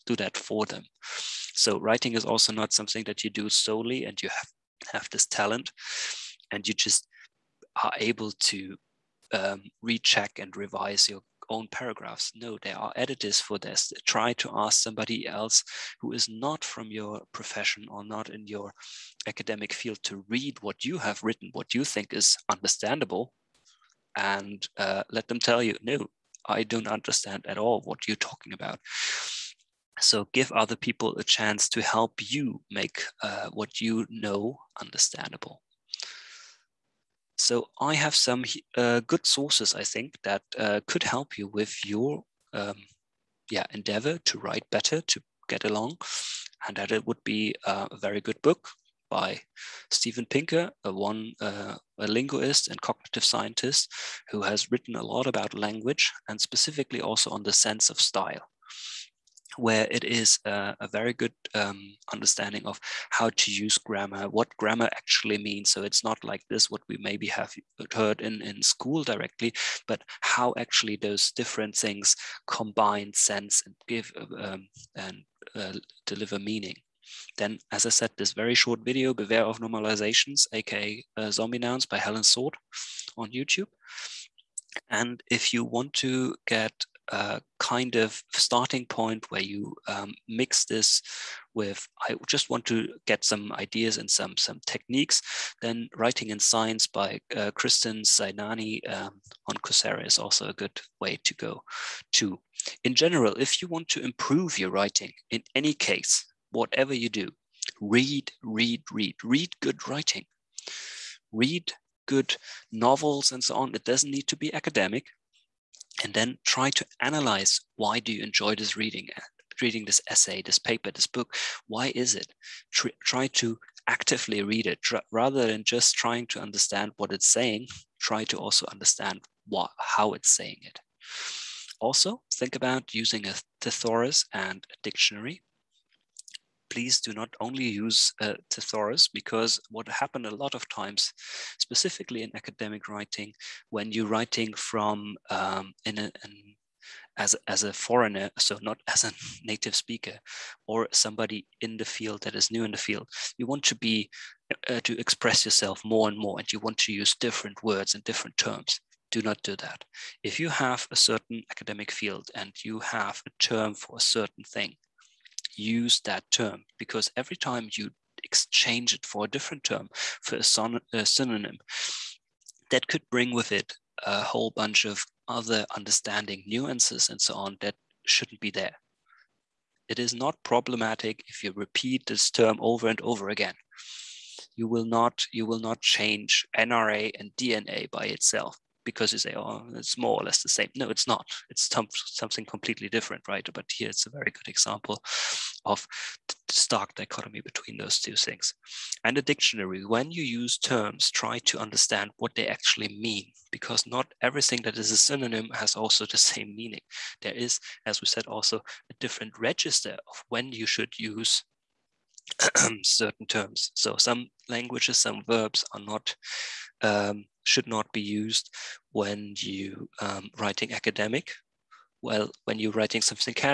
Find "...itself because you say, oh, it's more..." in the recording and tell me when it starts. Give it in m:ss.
3:08.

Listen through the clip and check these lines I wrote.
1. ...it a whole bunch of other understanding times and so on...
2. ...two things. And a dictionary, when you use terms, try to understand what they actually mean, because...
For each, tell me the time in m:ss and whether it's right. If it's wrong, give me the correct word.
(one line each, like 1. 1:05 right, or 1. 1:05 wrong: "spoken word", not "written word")
1. 2:53 wrong: "nuances", not "times"
2. 3:17 right.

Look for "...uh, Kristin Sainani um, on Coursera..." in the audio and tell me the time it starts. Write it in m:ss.
1:37.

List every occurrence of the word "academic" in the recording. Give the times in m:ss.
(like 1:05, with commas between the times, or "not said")
0:19, 1:54, 2:22, 2:41, 3:40.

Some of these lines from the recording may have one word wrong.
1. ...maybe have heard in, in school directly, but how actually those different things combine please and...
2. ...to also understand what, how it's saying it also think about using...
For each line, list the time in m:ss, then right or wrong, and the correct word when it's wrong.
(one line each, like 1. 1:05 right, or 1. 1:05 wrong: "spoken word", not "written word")
1. 1:07 wrong: "sense", not "please"
2. 2:08 right.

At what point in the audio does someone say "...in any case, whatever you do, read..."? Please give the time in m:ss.
1:45.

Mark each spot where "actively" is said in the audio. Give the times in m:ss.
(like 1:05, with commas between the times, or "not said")
2:03.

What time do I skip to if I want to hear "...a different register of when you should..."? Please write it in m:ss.
3:28.